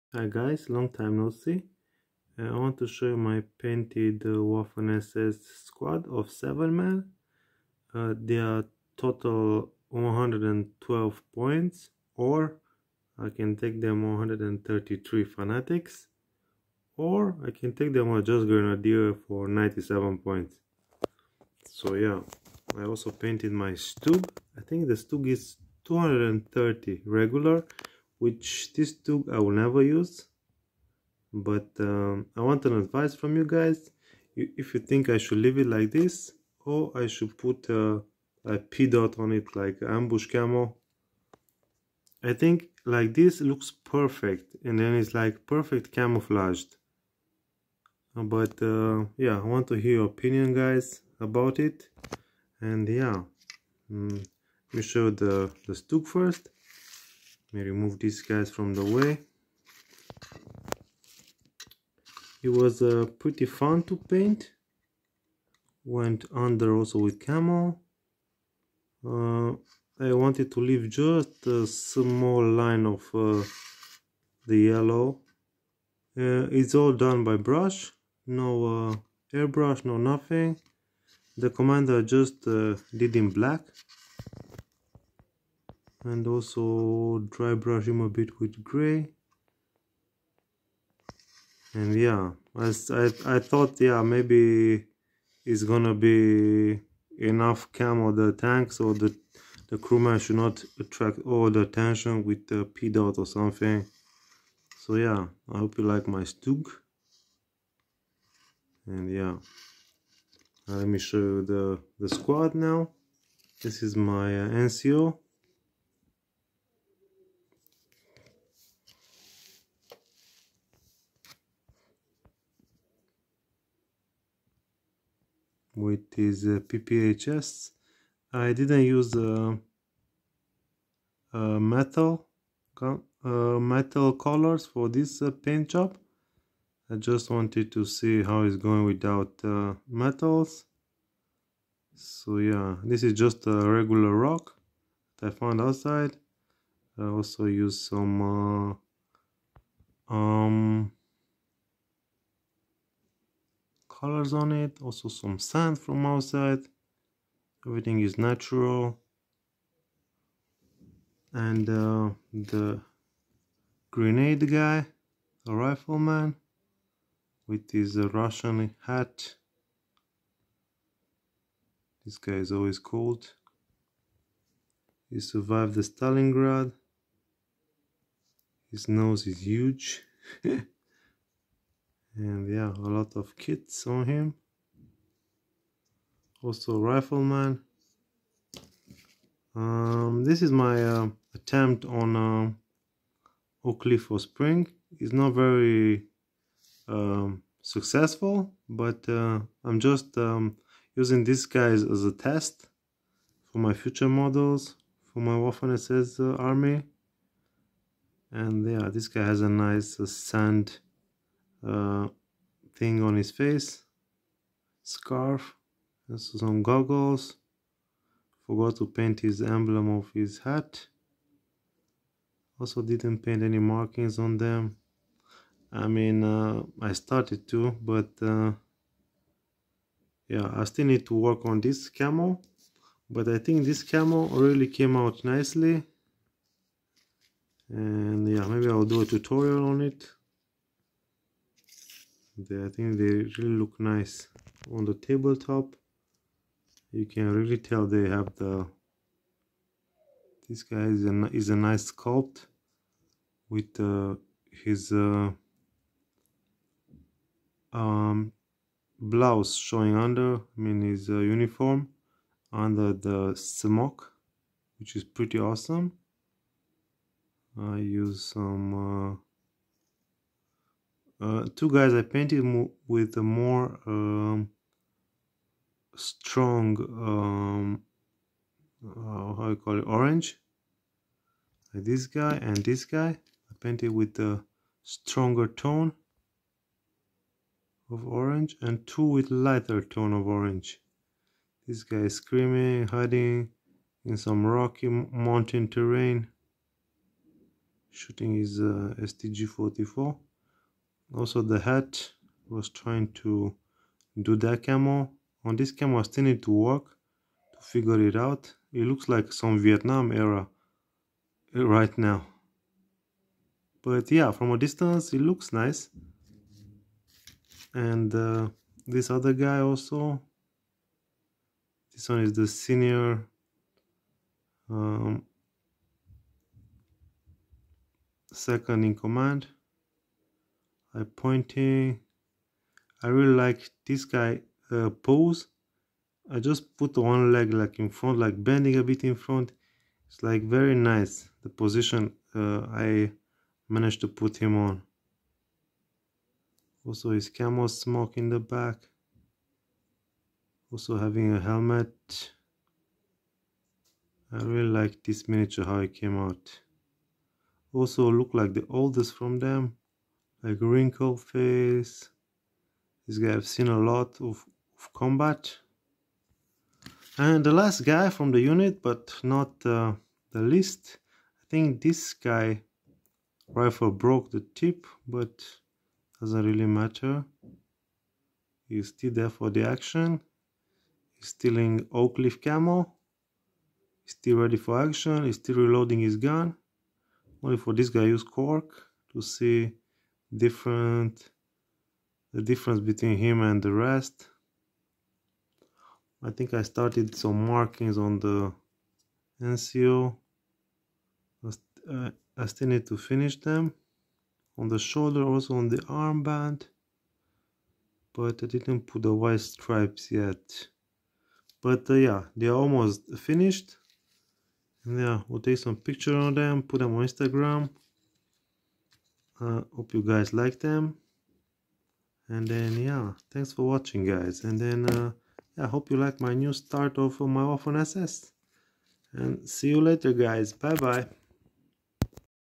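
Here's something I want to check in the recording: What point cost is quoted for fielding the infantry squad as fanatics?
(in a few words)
133.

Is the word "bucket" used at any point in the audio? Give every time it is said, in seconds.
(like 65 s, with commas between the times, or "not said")
not said.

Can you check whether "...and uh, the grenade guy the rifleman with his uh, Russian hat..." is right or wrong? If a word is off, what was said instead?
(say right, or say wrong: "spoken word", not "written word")
right.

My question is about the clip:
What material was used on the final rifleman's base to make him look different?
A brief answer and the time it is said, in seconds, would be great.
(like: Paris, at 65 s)
cork, at 388 s.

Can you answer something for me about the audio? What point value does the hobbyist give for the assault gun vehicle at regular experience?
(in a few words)
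230.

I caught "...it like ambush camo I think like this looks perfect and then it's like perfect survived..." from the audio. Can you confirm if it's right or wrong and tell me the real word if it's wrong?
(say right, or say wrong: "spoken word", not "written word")
wrong: "camouflaged", not "survived".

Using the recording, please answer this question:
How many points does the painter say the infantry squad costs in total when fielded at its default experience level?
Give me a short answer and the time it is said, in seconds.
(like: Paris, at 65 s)
112 points, at 9 s.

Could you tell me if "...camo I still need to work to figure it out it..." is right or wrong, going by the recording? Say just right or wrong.
right.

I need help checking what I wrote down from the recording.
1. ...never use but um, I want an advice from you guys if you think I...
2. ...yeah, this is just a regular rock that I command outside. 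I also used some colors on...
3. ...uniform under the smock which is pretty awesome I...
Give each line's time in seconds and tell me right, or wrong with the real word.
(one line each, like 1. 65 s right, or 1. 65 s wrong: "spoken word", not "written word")
1. 29 s right
2. 142 s wrong: "found", not "command"
3. 261 s right.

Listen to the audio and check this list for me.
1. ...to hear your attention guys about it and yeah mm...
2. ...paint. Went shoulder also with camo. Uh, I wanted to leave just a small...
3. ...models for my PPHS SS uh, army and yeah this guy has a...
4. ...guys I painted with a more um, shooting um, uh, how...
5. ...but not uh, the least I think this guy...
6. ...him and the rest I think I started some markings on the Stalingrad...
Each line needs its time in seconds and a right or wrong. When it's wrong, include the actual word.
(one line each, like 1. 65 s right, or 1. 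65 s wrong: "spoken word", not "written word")
1. 49 s wrong: "opinion", not "attention"
2. 63 s wrong: "under", not "shoulder"
3. 204 s wrong: "Waffen", not "PPHS"
4. 271 s wrong: "strong", not "shooting"
5. 368 s right
6. 393 s wrong: "NCO", not "Stalingrad".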